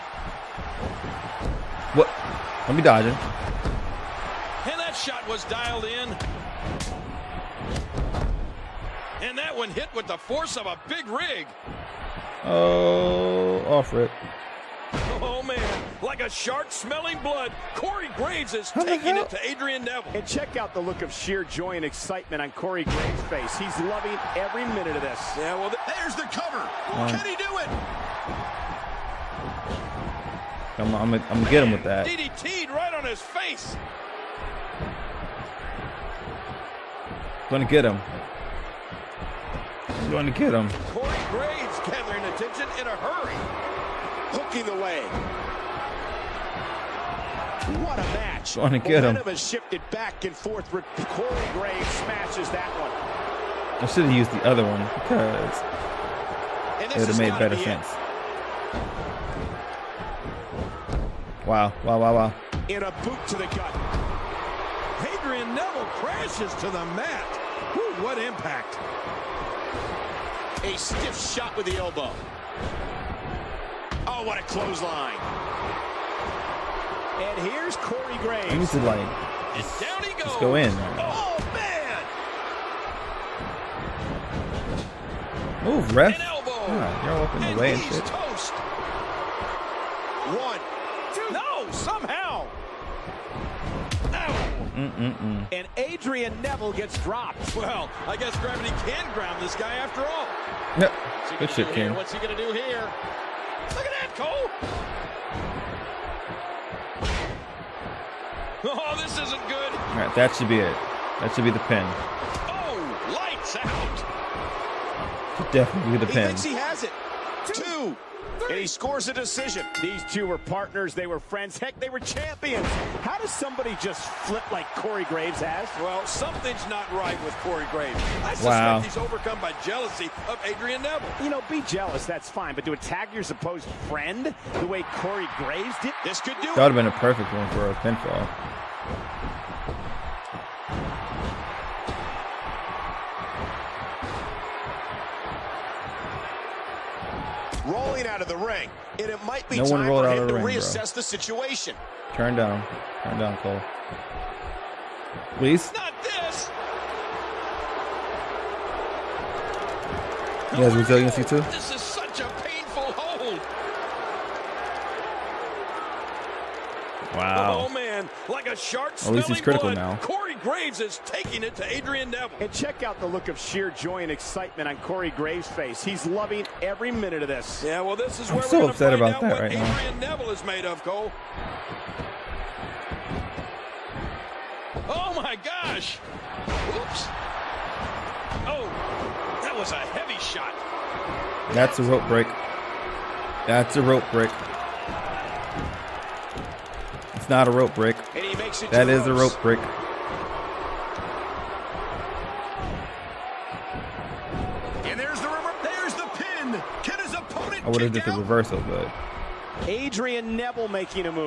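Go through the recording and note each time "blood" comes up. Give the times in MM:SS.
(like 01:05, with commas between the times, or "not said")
00:17, 02:49.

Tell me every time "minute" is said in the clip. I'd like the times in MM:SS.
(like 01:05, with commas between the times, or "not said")
00:24, 02:56.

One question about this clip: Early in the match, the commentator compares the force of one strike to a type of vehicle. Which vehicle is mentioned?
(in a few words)
big rig.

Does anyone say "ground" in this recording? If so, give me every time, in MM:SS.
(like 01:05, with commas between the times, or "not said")
01:39.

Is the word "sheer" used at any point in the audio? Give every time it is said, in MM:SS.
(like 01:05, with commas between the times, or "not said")
00:21, 02:53.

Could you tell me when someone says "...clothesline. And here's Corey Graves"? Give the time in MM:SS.
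01:14.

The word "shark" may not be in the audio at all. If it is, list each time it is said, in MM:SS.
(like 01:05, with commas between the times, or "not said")
00:16, 02:48.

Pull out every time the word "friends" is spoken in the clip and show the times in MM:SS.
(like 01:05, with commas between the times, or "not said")
02:01, 02:13.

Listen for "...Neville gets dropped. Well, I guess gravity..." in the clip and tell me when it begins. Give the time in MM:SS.
01:36.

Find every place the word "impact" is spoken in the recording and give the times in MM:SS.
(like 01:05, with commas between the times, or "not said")
01:08.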